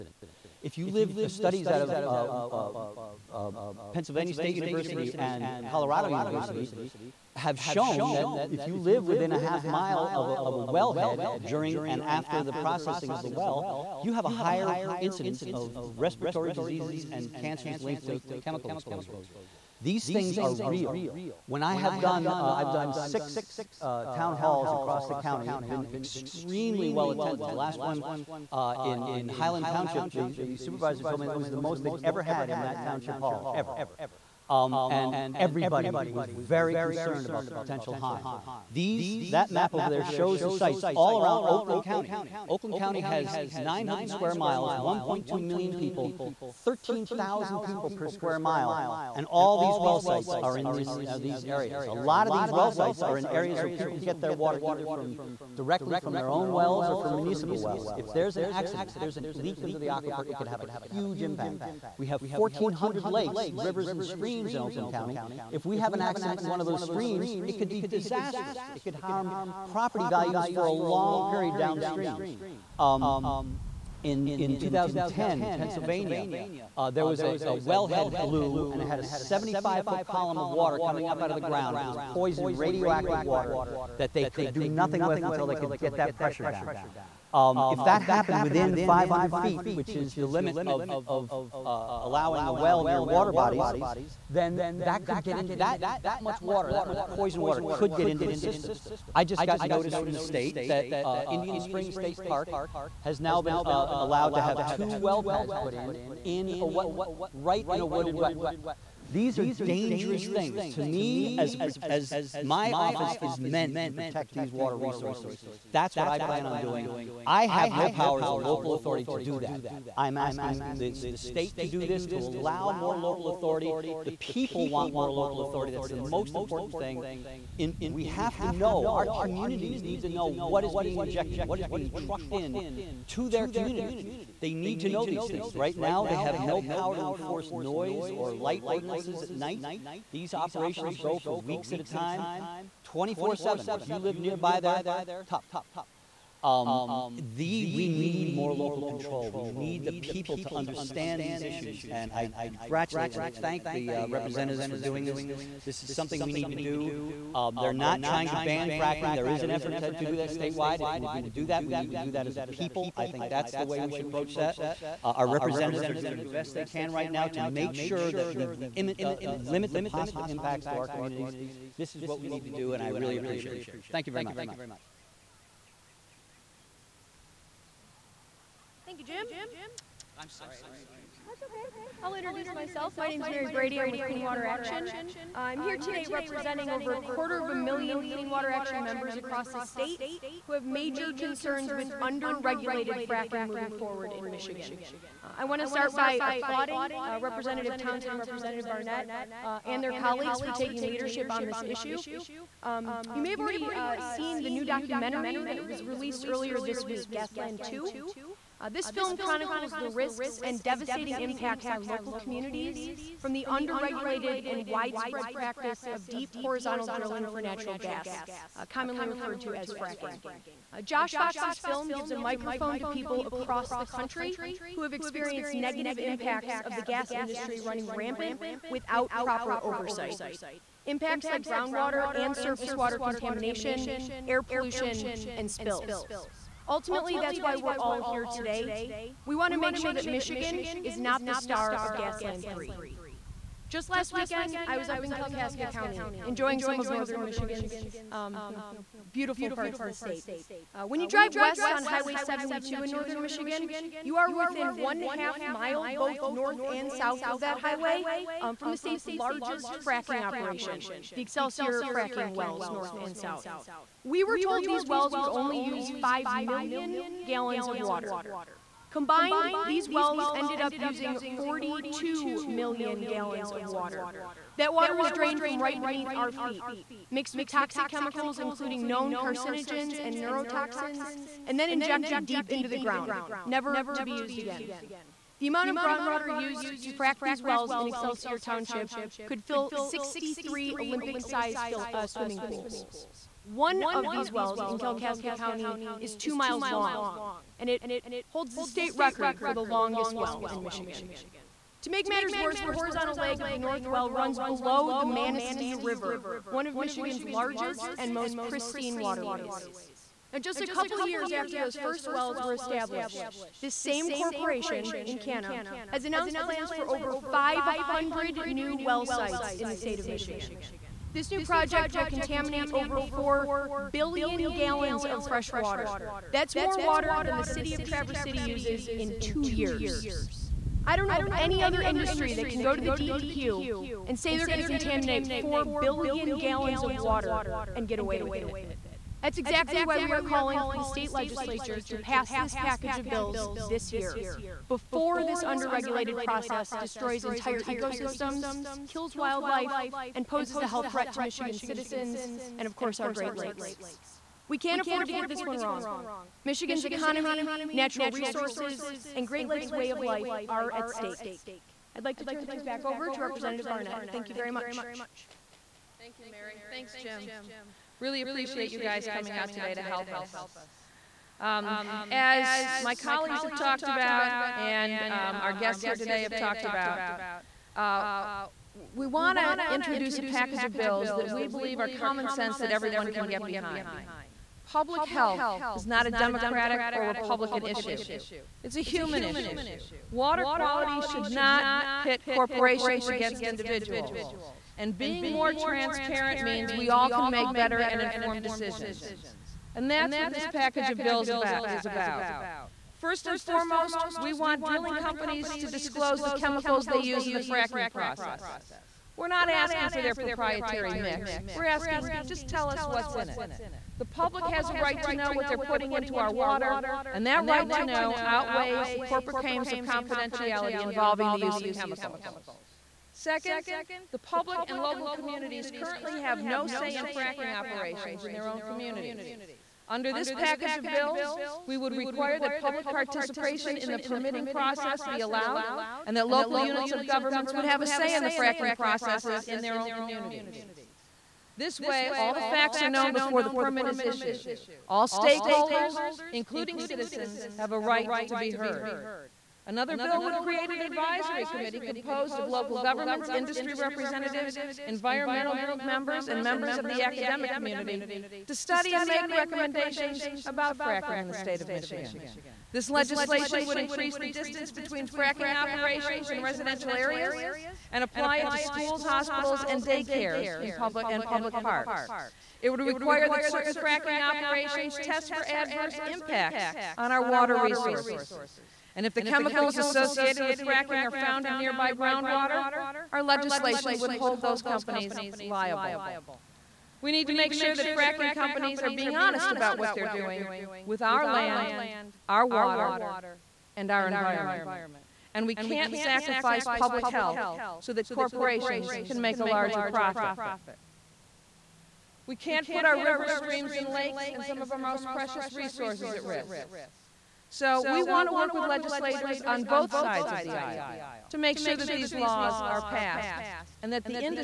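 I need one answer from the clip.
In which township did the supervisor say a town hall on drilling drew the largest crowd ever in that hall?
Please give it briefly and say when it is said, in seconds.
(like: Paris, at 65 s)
Highland Township, at 29 s.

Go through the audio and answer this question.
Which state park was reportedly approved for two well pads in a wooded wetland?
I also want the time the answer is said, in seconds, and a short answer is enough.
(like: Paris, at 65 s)
Indian Springs State Park, at 101 s.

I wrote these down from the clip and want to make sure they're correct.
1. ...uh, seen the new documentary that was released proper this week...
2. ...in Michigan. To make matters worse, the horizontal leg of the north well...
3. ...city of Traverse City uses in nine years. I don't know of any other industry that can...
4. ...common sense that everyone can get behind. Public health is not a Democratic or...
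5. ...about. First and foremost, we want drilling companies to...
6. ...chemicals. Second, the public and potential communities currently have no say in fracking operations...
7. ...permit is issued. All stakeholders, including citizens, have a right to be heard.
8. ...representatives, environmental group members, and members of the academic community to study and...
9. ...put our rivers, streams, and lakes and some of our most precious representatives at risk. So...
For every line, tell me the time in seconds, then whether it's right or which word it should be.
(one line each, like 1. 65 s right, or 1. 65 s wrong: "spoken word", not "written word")
1. 203 s wrong: "earlier", not "proper"
2. 300 s right
3. 327 s wrong: "two", not "nine"
4. 381 s right
5. 401 s right
6. 421 s wrong: "local", not "potential"
7. 443 s right
8. 453 s right
9. 502 s wrong: "resources", not "representatives".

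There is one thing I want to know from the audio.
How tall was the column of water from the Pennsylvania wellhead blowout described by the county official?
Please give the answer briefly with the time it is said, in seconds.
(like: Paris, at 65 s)
75-foot, at 79 s.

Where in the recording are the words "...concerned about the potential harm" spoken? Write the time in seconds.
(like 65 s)
36 s.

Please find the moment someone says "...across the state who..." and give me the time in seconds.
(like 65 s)
189 s.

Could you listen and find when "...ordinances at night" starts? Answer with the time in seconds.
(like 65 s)
138 s.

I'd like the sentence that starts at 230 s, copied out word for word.
Impacts like groundwater and surface water contamination, air pollution, and spills.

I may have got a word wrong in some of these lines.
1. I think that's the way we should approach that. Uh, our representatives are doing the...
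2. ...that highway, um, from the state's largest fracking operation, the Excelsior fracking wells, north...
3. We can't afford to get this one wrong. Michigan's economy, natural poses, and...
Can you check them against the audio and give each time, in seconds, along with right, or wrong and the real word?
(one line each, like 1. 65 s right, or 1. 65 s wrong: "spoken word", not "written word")
1. 162 s right
2. 257 s right
3. 354 s wrong: "resources", not "poses".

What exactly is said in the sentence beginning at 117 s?
I have no power as a local authority to do that.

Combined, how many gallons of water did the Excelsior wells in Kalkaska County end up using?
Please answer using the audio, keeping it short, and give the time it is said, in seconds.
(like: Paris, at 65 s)
42 million, at 271 s.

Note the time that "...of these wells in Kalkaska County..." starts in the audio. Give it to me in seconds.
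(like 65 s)
293 s.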